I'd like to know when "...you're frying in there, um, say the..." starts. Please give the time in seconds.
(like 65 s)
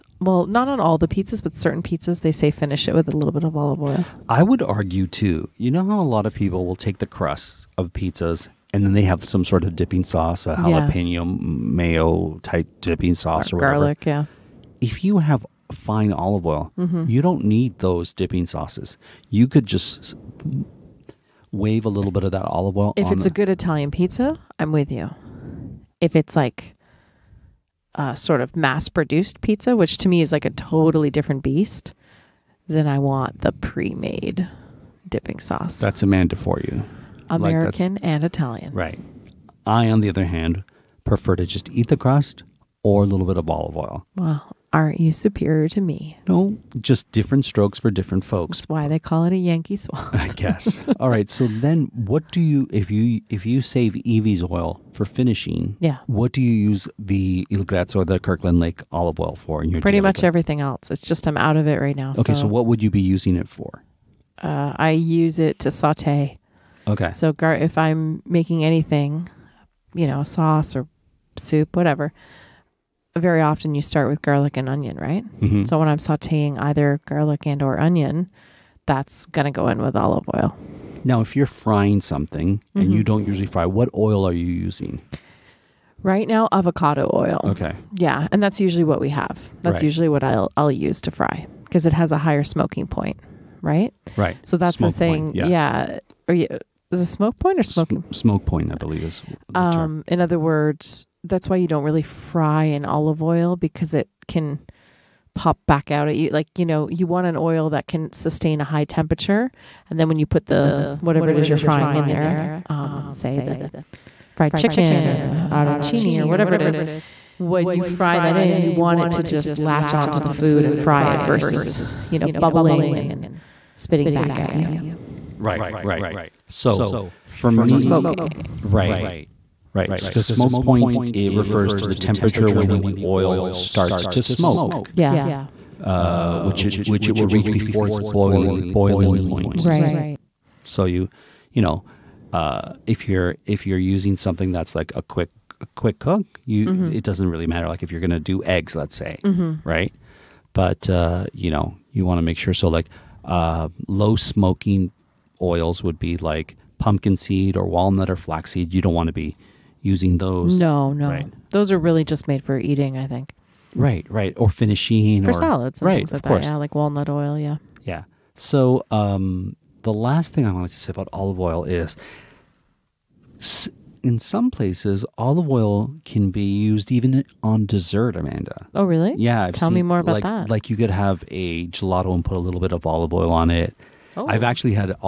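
111 s.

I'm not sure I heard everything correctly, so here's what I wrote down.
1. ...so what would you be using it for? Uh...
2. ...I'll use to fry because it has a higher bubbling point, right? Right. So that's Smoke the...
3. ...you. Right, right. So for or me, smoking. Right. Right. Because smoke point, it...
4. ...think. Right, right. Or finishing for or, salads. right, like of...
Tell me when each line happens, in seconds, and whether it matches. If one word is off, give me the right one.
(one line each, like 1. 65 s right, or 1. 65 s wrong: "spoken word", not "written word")
1. 62 s right
2. 90 s wrong: "smoking", not "bubbling"
3. 124 s right
4. 163 s right.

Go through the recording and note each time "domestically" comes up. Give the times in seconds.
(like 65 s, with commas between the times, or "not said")
not said.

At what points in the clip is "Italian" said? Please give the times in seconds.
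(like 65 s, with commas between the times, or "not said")
23 s, 38 s.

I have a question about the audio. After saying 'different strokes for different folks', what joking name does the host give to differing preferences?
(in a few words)
Yankee swap.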